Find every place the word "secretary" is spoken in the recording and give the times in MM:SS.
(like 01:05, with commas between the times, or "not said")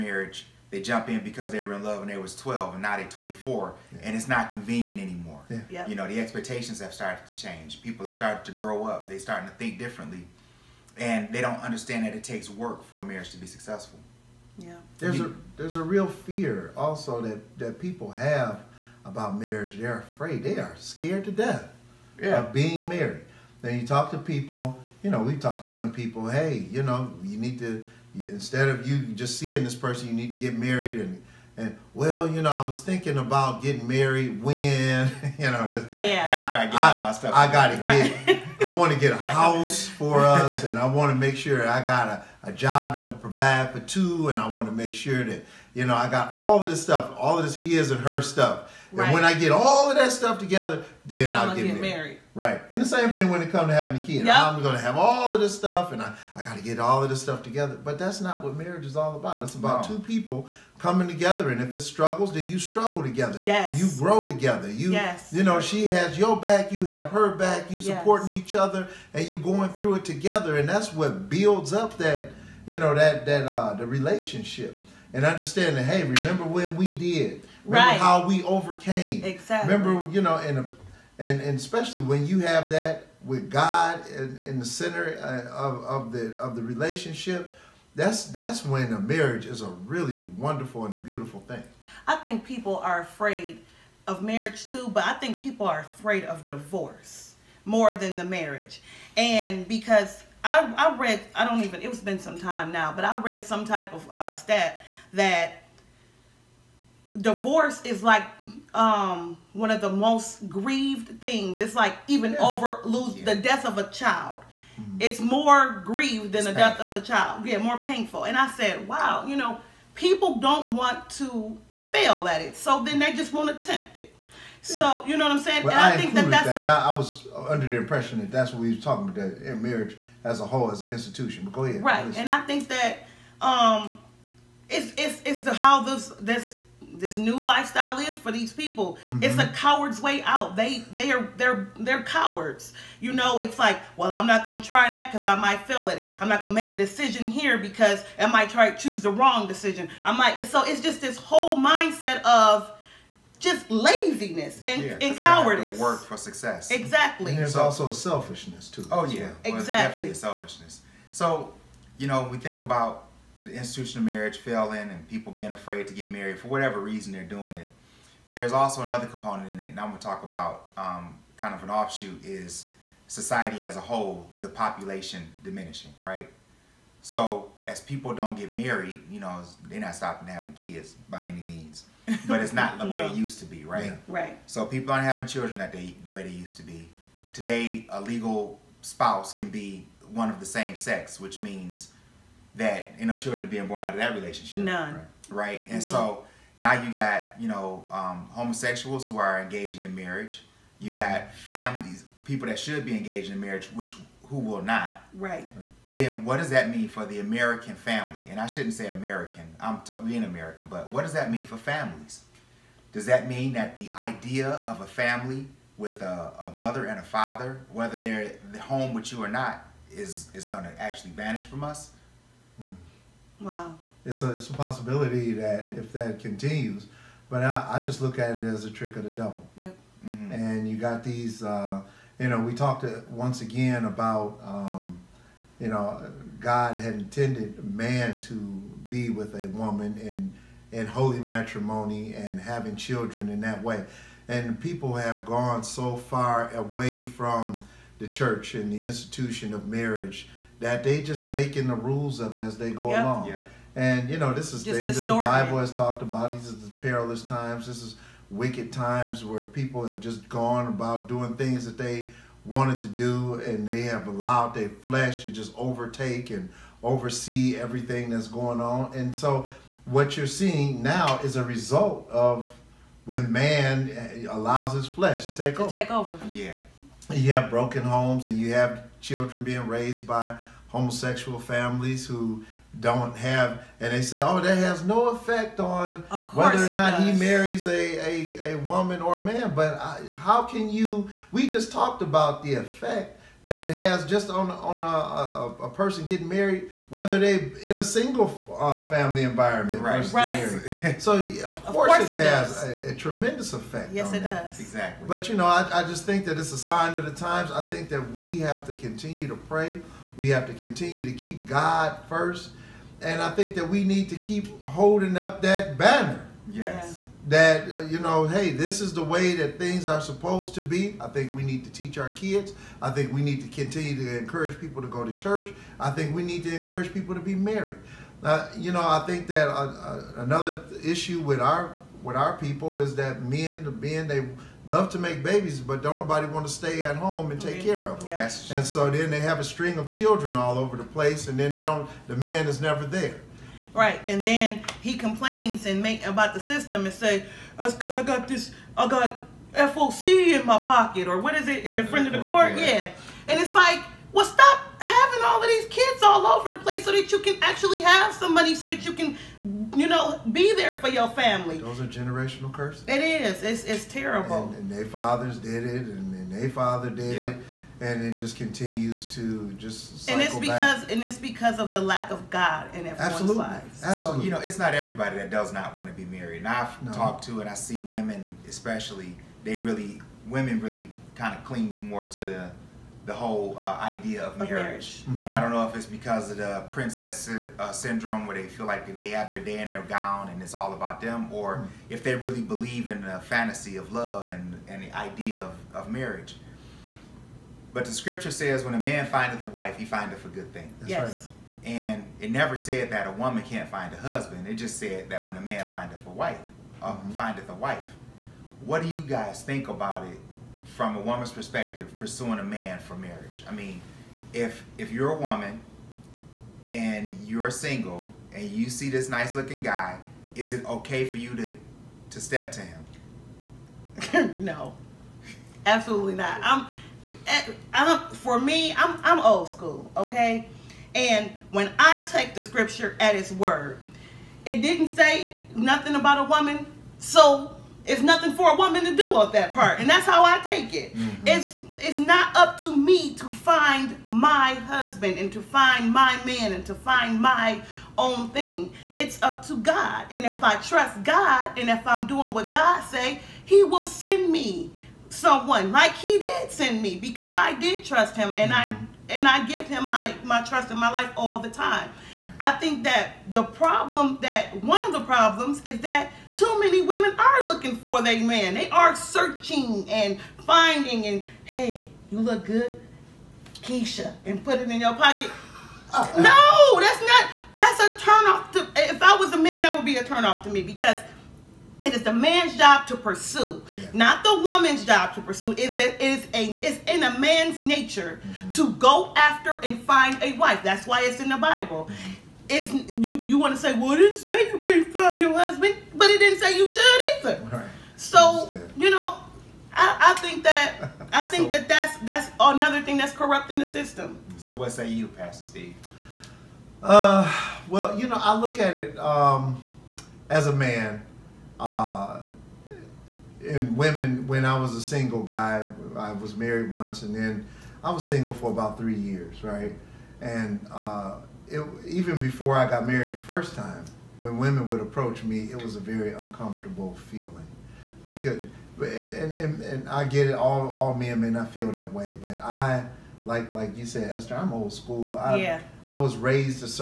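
not said.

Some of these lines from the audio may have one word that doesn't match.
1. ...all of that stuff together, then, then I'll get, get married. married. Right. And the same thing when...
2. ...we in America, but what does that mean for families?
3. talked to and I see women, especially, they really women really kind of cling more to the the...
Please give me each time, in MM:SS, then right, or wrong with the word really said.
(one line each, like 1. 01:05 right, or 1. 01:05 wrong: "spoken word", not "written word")
1. 00:49 right
2. 03:30 right
3. 06:16 right.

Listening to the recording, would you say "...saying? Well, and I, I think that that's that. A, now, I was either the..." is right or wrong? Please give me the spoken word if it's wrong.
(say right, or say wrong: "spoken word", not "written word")
wrong: "under", not "either".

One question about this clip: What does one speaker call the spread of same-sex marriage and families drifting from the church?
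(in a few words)
a trick of the devil.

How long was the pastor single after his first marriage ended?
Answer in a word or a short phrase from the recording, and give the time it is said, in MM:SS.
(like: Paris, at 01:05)
3 years, at 08:38.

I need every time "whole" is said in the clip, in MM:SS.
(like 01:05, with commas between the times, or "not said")
02:10, 02:31, 02:53, 06:23.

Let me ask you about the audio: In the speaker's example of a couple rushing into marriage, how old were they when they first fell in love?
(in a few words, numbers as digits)
12.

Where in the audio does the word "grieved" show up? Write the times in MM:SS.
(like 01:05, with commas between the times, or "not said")
01:50, 01:55.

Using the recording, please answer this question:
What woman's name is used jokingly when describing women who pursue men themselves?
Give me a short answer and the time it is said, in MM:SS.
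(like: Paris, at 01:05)
Keisha, at 07:53.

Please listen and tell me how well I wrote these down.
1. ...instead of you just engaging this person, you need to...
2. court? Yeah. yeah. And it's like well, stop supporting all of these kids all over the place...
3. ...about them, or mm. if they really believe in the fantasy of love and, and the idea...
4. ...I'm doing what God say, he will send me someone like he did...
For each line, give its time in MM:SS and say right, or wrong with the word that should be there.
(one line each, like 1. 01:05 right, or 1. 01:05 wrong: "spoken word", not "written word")
1. 00:28 wrong: "seeing", not "engaging"
2. 05:52 wrong: "having", not "supporting"
3. 06:30 right
4. 07:31 right.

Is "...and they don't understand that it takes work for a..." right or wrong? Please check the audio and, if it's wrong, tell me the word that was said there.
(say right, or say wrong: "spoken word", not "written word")
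right.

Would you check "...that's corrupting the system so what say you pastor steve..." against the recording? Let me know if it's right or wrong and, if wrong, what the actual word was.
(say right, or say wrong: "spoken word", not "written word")
right.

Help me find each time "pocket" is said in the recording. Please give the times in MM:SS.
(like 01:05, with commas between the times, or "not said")
05:50, 07:54.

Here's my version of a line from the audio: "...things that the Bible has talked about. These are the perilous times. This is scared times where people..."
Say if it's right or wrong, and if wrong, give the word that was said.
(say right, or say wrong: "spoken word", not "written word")
wrong: "wicked", not "scared".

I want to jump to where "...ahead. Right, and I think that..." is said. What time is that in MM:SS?
02:11.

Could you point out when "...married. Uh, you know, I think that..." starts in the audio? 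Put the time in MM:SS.
05:27.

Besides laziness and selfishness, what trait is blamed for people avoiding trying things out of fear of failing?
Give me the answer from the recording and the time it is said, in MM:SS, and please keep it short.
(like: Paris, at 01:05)
cowardice, at 02:35.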